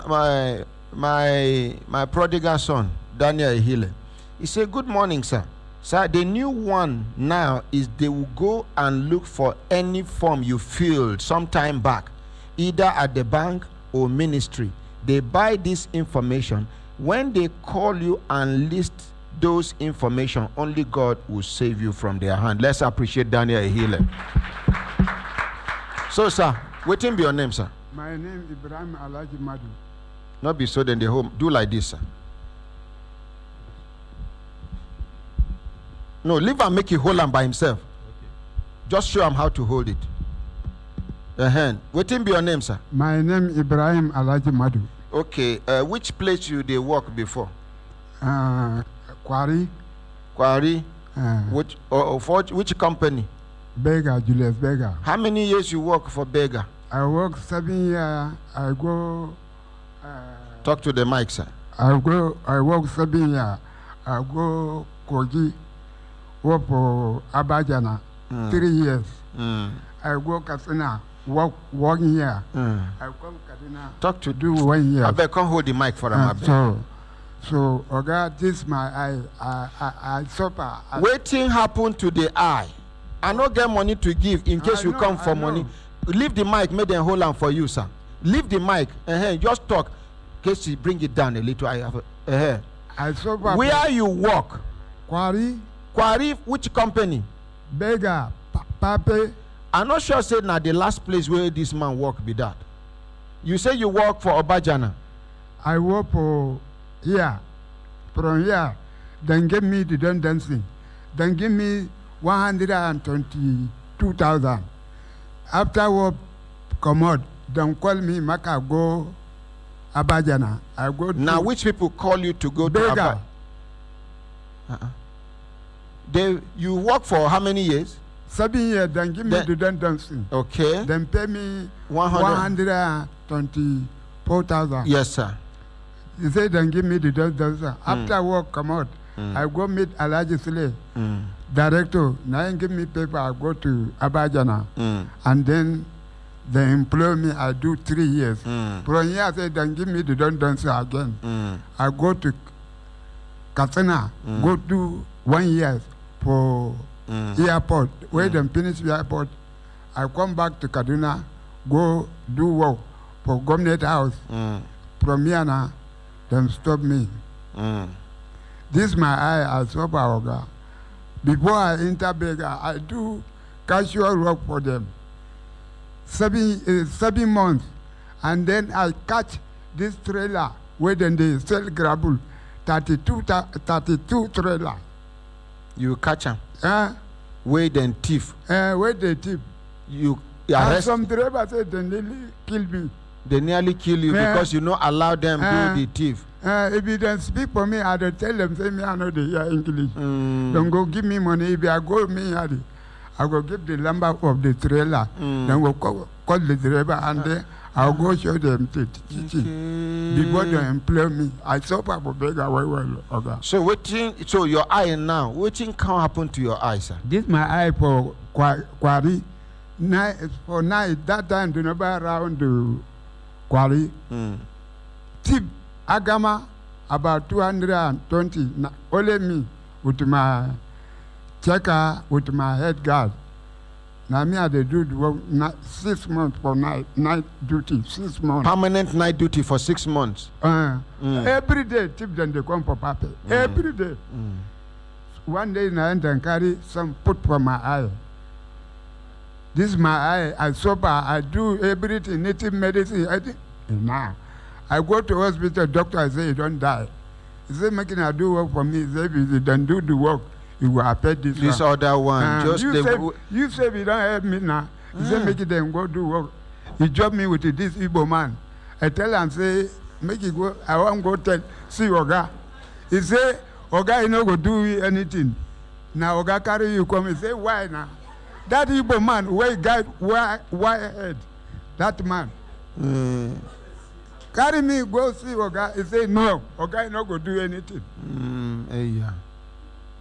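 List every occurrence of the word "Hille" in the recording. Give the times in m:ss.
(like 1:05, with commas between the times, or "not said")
0:03, 0:23.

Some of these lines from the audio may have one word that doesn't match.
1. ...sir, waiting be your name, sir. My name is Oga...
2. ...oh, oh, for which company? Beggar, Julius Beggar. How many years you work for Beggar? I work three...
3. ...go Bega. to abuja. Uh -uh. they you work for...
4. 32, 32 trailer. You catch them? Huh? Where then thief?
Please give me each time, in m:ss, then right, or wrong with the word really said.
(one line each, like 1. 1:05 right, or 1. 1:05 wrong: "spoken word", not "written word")
1. 0:26 wrong: "Ibrahim", not "Oga"
2. 0:52 wrong: "seven", not "three"
3. 2:02 right
4. 3:02 right.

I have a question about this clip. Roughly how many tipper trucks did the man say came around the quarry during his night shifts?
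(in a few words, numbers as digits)
220.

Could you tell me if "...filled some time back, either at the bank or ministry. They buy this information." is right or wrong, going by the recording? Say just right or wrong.
right.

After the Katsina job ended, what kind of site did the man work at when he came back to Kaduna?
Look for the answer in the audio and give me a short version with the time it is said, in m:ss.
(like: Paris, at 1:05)
Government House, at 2:43.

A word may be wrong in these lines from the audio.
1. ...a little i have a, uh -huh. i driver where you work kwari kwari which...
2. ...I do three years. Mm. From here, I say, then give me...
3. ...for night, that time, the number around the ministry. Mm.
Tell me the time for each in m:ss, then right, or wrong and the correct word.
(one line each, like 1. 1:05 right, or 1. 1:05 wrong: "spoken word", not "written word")
1. 1:31 wrong: "suffer", not "driver"
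2. 2:27 right
3. 3:40 wrong: "quarry", not "ministry".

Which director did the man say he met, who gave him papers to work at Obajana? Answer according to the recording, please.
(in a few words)
Alhaji Sule.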